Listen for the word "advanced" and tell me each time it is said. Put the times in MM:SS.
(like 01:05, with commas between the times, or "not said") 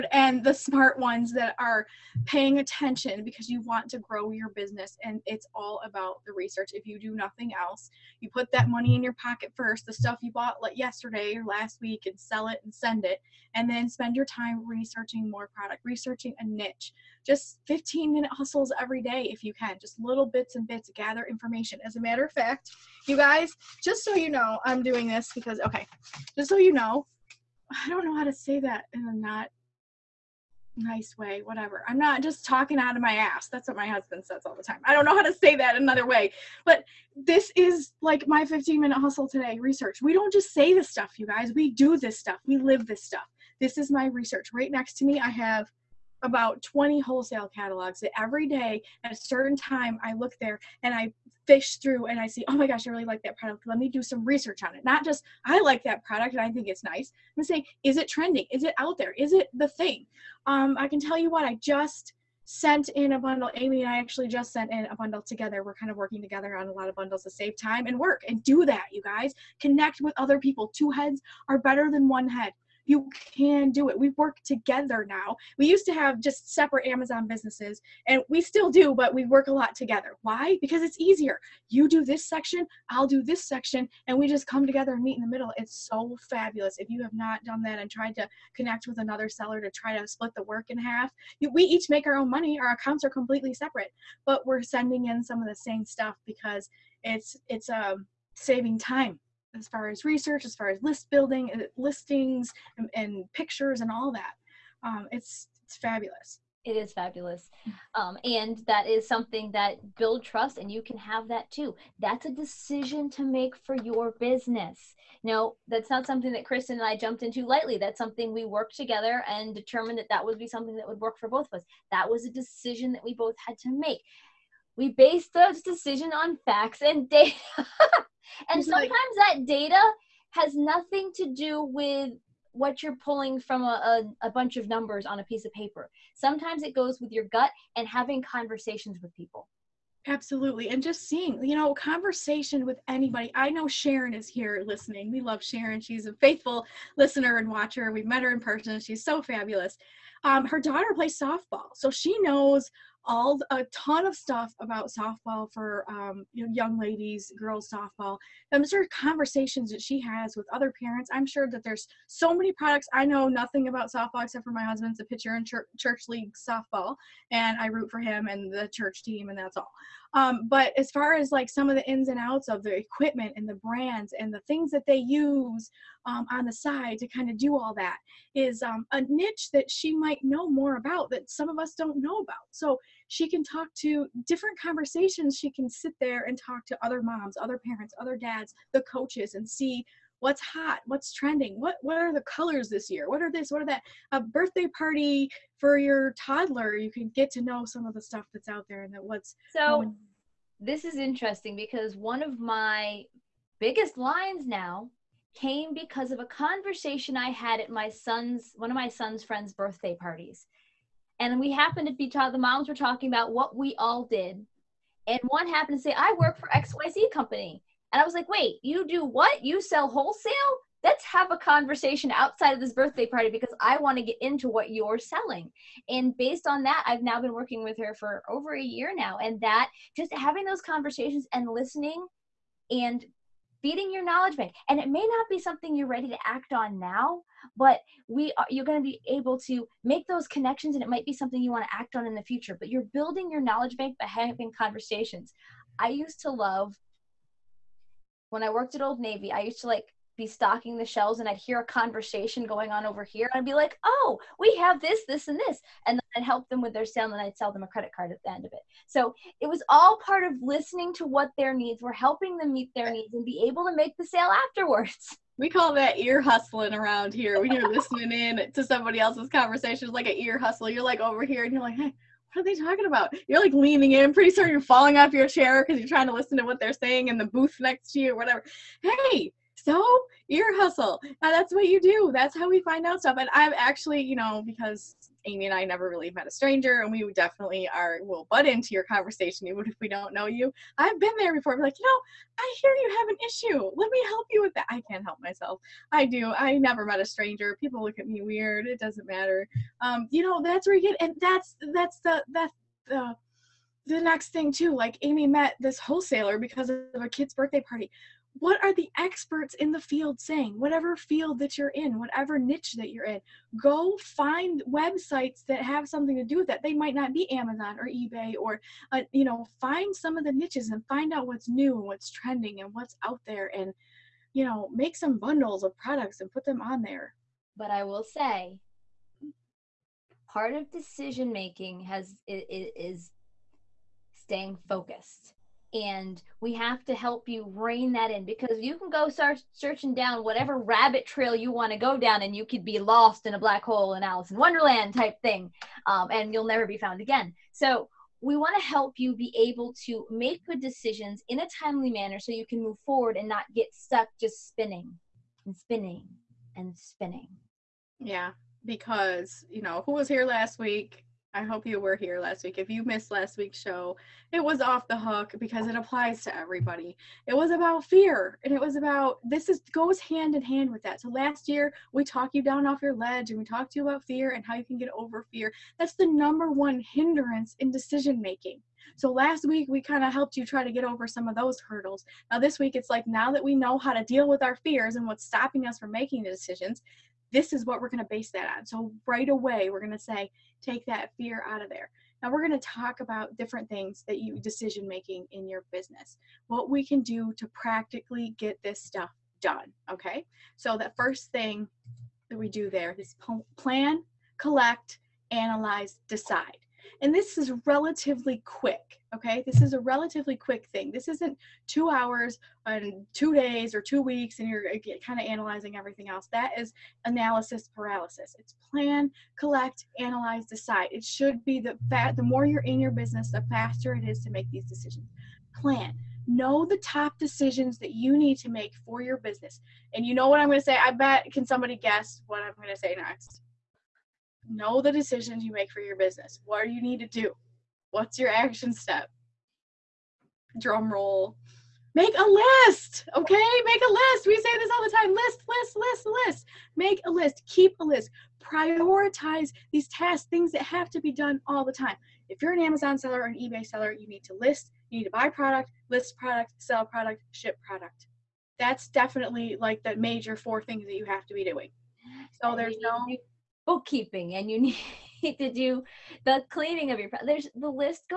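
not said.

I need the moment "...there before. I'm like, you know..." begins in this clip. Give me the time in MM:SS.
04:51.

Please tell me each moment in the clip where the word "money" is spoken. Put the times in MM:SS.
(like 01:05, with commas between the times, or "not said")
00:08, 01:32.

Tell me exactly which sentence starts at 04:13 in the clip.
and I'd be like, oh, we have this, this, and this.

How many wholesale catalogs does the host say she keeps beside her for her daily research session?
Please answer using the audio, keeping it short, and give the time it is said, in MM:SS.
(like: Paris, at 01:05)
20, at 00:46.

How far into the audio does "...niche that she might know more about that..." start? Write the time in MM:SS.
02:59.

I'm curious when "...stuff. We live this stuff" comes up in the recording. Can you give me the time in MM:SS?
00:42.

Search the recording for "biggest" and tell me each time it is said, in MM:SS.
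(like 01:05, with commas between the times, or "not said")
03:23.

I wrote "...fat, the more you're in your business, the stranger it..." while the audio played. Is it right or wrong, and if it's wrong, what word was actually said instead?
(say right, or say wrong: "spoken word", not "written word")
wrong: "faster", not "stranger".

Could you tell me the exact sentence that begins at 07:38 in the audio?
That's definitely like the major four things that you have to be doing.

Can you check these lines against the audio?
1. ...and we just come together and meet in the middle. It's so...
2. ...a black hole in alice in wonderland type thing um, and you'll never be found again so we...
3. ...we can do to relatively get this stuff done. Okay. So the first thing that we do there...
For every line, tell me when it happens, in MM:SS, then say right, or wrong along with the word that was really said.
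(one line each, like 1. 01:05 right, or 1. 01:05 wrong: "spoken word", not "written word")
1. 01:24 right
2. 05:43 right
3. 06:36 wrong: "practically", not "relatively".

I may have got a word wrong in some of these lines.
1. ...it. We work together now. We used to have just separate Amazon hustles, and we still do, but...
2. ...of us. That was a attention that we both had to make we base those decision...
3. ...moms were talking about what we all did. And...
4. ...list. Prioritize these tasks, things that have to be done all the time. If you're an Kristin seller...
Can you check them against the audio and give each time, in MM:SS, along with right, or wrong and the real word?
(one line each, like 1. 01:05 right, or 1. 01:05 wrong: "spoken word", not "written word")
1. 01:13 wrong: "businesses", not "hustles"
2. 02:01 wrong: "decision", not "attention"
3. 03:32 right
4. 07:27 wrong: "Amazon", not "Kristin".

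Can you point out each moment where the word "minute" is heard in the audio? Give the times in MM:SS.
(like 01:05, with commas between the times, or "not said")
00:18, 00:38.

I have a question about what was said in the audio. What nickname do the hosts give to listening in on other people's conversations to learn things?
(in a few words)
ear hustling.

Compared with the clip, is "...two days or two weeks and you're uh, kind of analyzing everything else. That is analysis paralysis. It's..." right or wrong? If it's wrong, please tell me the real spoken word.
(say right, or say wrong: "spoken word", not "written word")
right.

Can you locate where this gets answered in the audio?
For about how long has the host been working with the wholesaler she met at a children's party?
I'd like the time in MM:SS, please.
03:47.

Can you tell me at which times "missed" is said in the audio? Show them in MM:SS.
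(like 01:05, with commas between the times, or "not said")
06:02.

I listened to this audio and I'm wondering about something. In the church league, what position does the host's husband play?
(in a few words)
pitcher.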